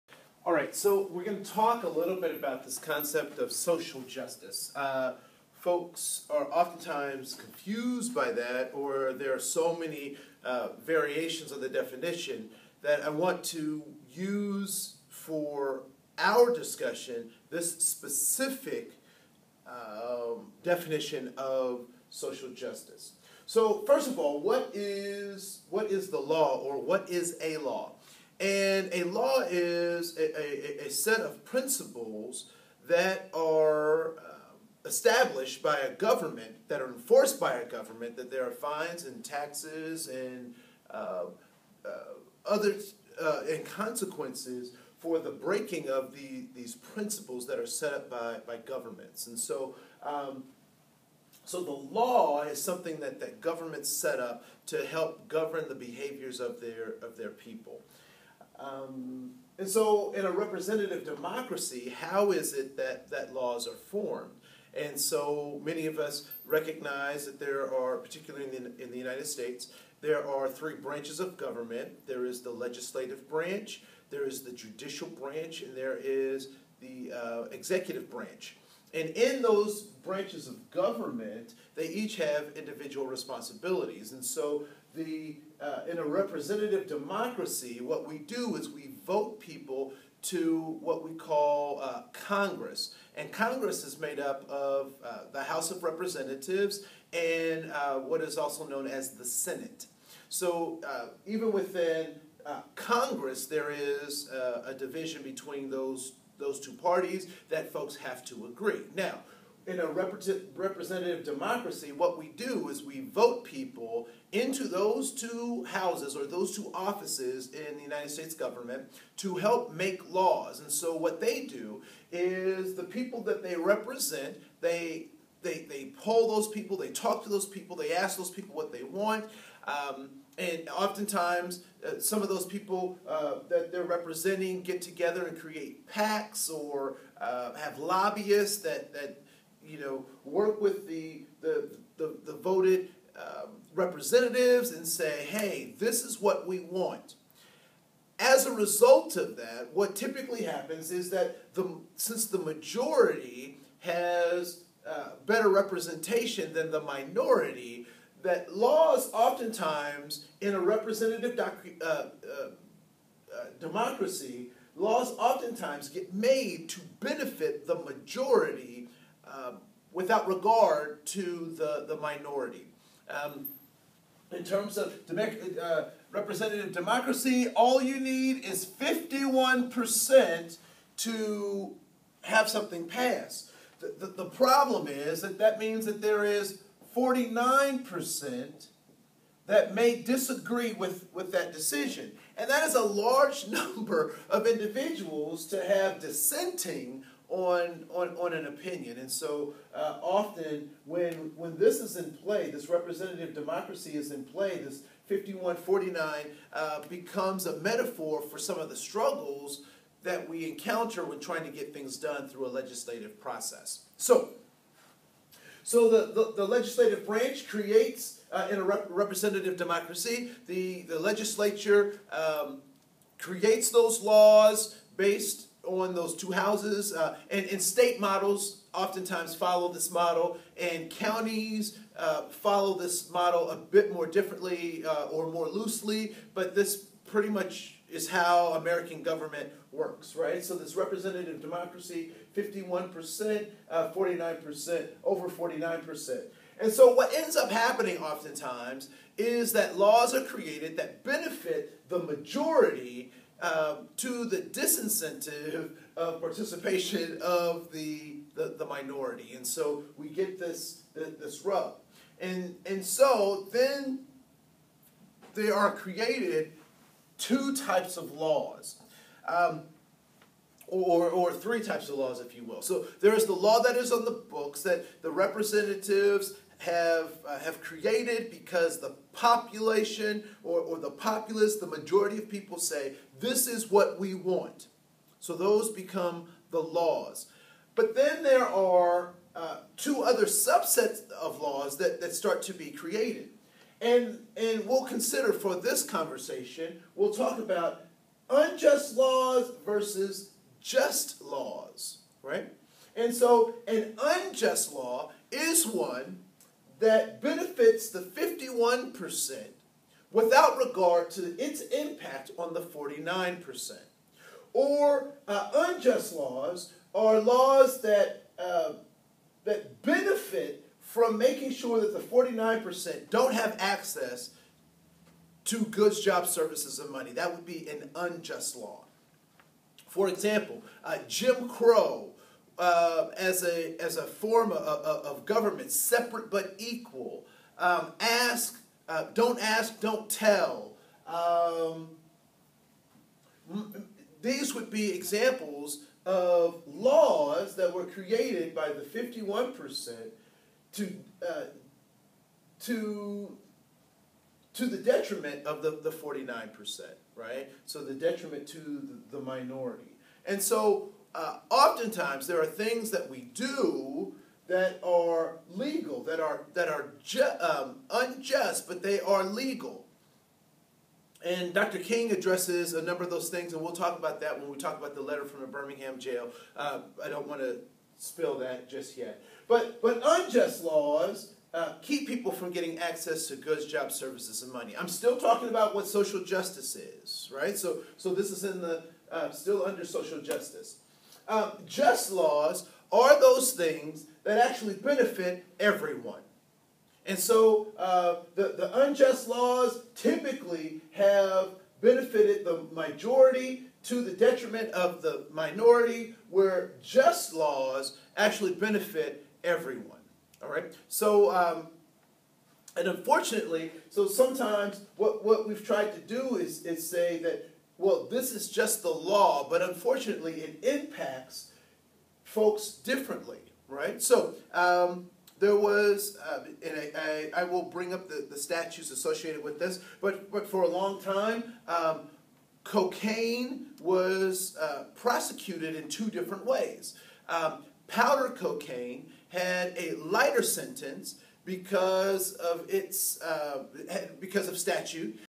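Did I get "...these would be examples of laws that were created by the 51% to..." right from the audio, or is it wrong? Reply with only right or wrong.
right.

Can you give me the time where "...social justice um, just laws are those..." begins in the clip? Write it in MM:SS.
06:29.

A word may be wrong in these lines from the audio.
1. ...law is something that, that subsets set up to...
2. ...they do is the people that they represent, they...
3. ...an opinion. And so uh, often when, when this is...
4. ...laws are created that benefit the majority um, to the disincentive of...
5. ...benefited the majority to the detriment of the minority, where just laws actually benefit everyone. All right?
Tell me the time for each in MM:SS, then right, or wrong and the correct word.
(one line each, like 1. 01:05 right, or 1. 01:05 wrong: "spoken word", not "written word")
1. 00:51 wrong: "governments", not "subsets"
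2. 02:01 right
3. 03:18 right
4. 04:09 right
5. 06:41 right.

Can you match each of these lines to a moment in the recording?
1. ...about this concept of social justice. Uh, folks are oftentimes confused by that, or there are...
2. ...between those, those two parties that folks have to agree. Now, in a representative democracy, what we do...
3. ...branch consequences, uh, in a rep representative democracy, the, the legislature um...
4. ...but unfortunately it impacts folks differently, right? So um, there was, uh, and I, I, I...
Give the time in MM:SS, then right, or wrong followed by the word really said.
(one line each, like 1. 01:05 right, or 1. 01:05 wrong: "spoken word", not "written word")
1. 00:02 right
2. 01:45 right
3. 03:37 wrong: "creates", not "consequences"
4. 06:59 right.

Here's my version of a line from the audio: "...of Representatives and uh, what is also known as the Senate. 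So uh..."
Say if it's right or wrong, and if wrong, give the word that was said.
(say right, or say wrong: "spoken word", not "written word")
right.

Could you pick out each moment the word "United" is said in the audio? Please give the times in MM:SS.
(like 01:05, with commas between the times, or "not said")
01:08, 01:57.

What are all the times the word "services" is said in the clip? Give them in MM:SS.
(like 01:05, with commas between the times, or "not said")
05:26, 06:23.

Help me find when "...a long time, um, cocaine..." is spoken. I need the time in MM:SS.
07:10.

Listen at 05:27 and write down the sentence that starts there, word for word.
That would be an unjust law.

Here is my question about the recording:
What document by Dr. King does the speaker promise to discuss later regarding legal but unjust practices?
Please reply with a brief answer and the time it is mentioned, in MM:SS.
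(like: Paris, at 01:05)
Letter from the Birmingham jail, at 06:15.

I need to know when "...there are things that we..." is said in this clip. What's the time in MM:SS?
06:02.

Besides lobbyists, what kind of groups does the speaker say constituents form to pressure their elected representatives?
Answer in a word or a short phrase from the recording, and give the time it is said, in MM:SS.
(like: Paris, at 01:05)
PACs, at 02:15.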